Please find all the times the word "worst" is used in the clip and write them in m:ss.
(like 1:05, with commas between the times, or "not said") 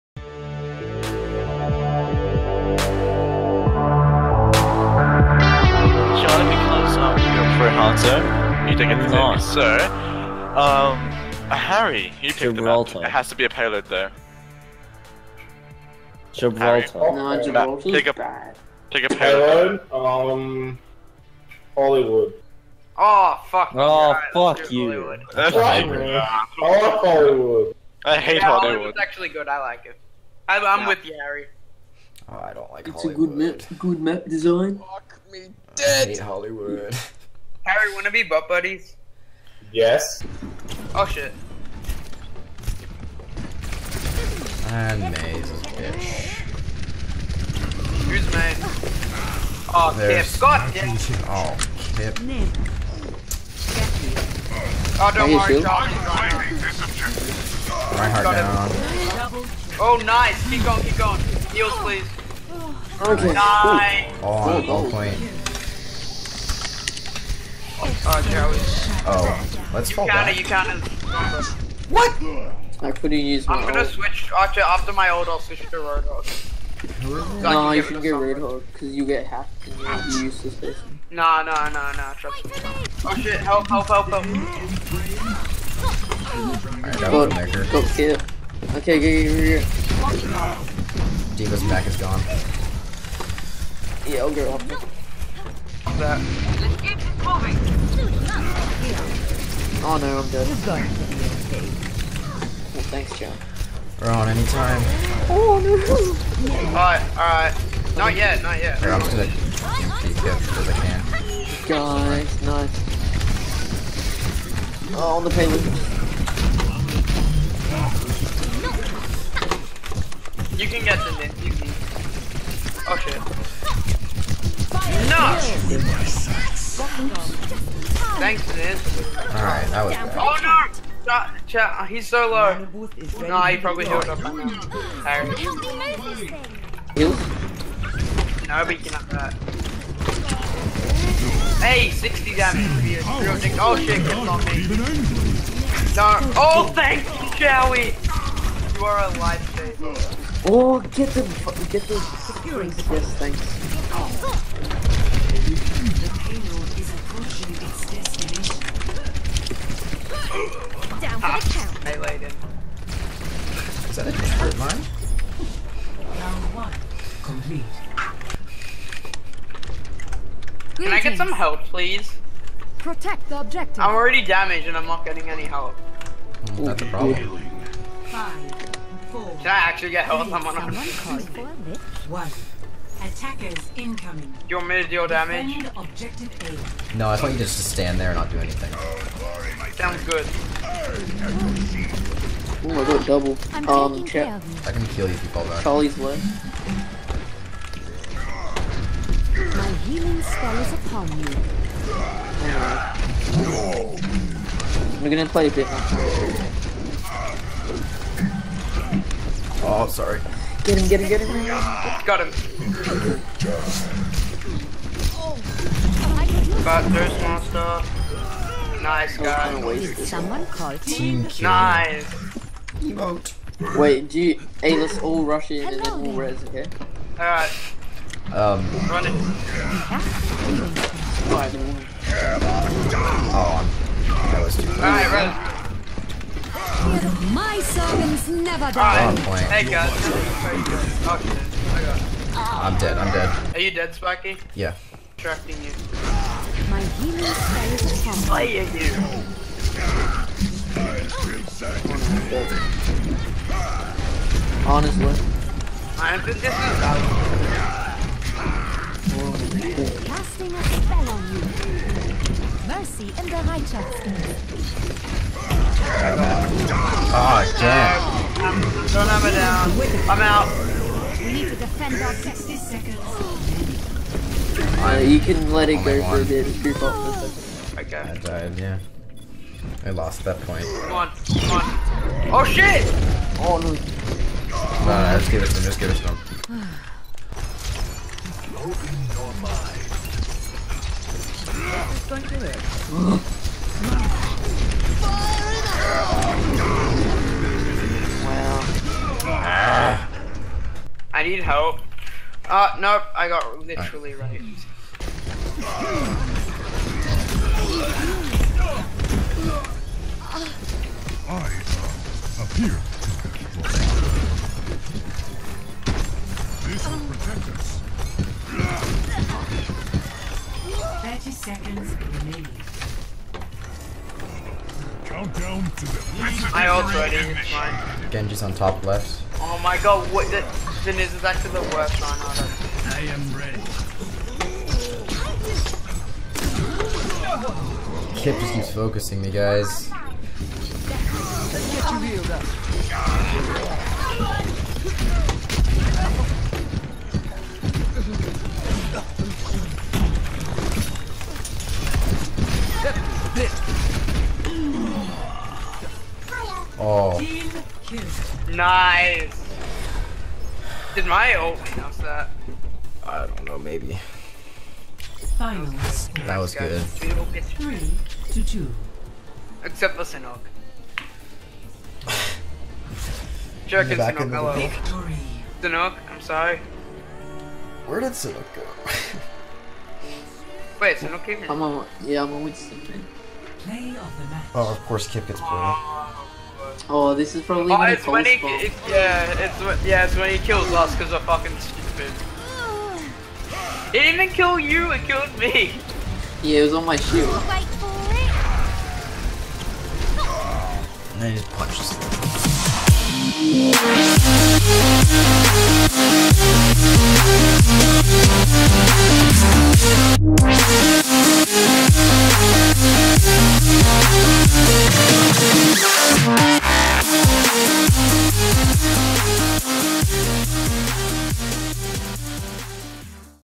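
5:31.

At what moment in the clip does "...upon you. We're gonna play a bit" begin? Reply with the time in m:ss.
3:20.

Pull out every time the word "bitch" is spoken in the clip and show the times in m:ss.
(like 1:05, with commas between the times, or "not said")
0:45.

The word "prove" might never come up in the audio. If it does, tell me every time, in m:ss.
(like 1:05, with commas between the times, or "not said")
not said.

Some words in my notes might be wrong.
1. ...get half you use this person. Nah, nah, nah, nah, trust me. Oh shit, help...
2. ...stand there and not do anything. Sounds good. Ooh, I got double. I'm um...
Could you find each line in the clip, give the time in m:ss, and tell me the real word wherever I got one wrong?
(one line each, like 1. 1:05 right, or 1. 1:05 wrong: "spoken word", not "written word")
1. 1:19 right
2. 3:07 right.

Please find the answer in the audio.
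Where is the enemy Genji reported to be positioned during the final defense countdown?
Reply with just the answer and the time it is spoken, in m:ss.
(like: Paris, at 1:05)
Top left, at 5:28.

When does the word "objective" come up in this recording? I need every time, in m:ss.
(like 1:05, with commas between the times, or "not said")
2:53.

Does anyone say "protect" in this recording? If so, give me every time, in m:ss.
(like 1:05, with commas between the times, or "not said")
2:52, 5:17.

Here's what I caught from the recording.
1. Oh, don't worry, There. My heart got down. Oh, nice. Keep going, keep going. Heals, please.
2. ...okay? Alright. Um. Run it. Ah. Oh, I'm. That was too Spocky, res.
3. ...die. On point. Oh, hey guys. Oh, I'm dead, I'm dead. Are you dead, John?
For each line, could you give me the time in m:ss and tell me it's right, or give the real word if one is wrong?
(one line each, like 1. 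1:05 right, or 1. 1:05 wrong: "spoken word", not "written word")
1. 0:55 wrong: "John", not "There"
2. 3:46 wrong: "Alright", not "Spocky"
3. 3:58 wrong: "Spocky", not "John".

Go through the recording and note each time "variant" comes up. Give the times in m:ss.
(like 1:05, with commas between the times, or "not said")
not said.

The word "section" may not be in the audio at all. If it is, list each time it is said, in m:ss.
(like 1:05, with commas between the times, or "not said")
not said.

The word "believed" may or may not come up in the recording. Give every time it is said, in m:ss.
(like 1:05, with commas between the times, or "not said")
not said.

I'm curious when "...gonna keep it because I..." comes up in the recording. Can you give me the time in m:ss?
1:49.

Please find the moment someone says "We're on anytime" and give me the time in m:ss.
1:44.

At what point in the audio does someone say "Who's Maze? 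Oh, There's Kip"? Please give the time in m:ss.
0:48.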